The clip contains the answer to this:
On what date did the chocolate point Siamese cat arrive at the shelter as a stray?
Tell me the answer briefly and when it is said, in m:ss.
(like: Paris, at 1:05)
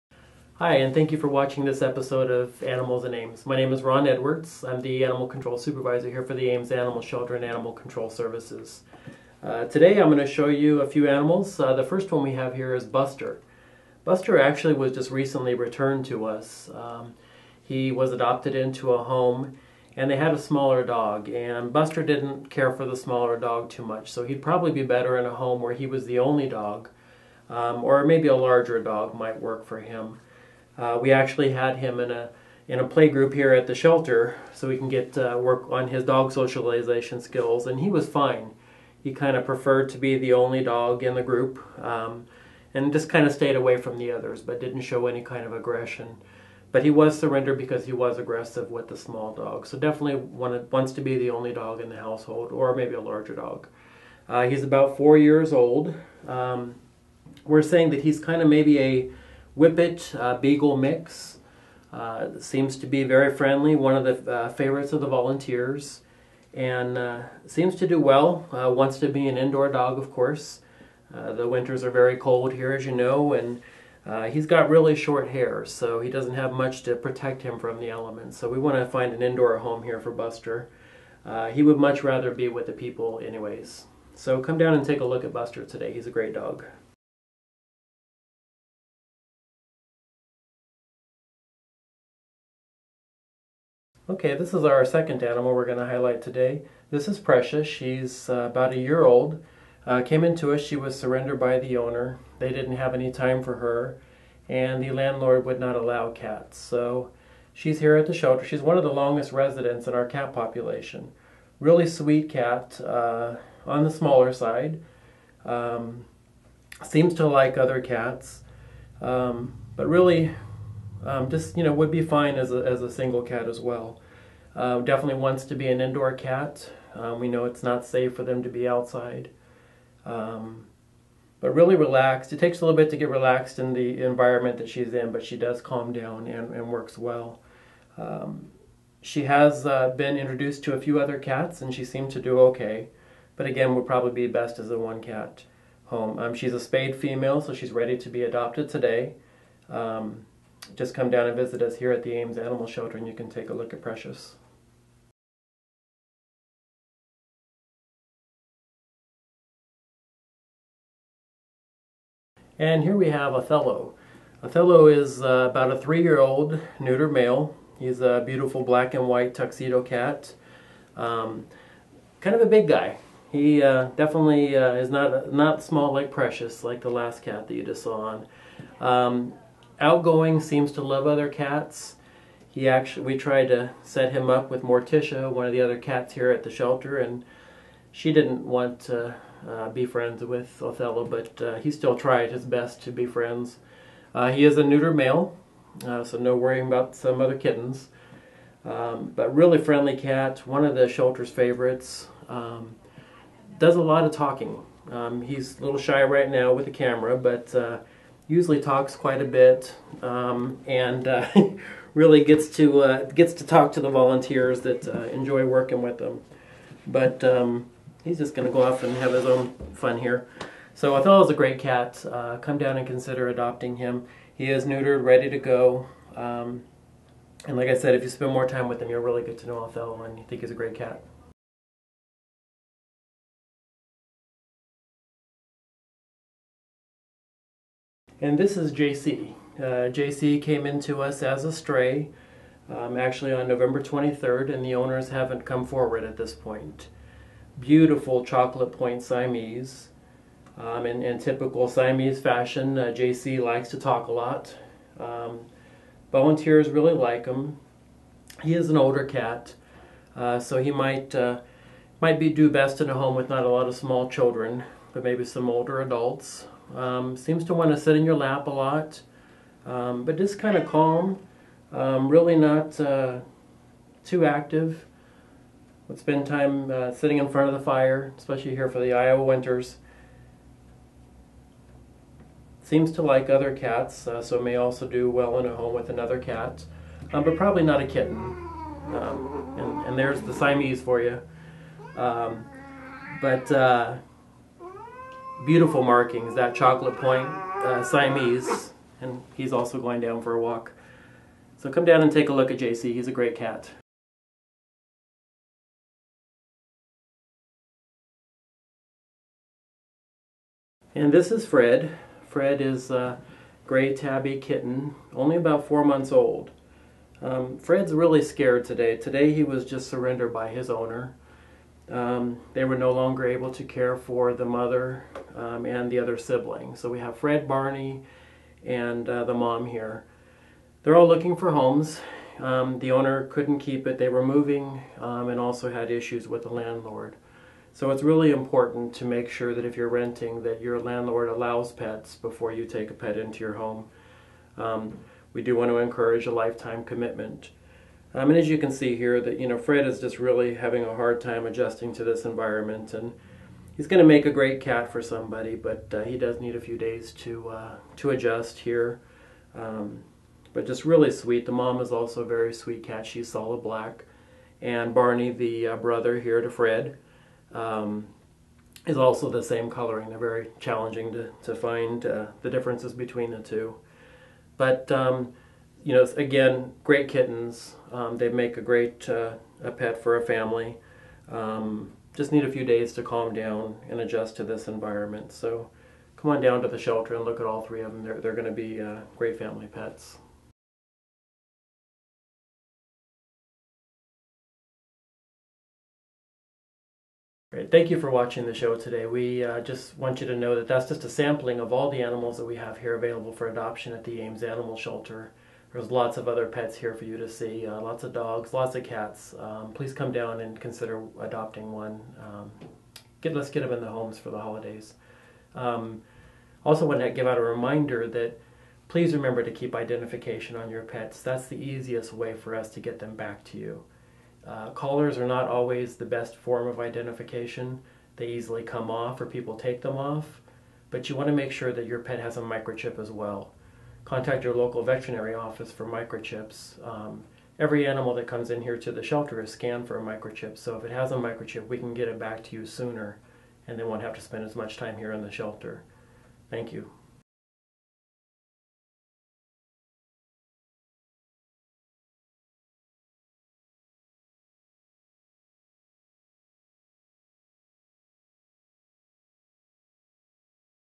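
November 23, at 4:03.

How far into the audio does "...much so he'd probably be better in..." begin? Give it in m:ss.
0:23.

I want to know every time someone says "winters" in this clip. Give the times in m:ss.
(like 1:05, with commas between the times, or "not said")
1:11, 4:39.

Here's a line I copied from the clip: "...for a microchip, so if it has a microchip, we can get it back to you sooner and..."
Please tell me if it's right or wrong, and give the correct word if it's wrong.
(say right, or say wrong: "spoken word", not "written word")
right.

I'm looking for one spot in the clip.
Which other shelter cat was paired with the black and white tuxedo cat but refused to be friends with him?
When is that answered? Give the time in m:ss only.
3:04.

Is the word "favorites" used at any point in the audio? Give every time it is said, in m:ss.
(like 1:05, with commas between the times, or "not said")
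1:04, 3:21.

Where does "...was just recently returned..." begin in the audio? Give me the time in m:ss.
0:14.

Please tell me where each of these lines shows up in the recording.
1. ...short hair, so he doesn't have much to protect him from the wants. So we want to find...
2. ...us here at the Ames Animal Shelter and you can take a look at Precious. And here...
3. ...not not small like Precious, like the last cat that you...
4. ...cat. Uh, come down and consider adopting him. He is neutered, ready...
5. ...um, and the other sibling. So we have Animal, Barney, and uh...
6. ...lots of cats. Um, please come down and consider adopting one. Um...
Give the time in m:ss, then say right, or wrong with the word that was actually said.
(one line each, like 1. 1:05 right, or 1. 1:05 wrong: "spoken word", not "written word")
1. 1:14 wrong: "elements", not "wants"
2. 2:31 right
3. 2:54 right
4. 3:41 right
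5. 5:25 wrong: "Fred", not "Animal"
6. 6:48 right.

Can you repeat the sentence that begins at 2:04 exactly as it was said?
Uh, definitely wants to be an indoor cat.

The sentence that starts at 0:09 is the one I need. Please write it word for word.
Uh, today I'm going to show you a few animals.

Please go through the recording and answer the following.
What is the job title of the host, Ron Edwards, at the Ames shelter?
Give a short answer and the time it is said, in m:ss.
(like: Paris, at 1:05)
Animal Control Supervisor, at 0:05.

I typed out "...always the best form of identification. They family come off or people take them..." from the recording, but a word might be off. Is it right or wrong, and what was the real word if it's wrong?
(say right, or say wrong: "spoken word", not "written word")
wrong: "easily", not "family".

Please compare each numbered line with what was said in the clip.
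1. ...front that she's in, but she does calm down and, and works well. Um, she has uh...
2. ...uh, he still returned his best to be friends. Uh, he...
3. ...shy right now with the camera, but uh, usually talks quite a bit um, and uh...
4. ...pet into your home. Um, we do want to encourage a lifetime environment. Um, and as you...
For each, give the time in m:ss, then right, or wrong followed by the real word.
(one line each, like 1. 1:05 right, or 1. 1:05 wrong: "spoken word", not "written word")
1. 2:14 wrong: "environment", not "front"
2. 3:11 wrong: "tried", not "returned"
3. 3:25 right
4. 5:42 wrong: "commitment", not "environment".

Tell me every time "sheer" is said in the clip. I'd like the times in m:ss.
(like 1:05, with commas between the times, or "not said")
not said.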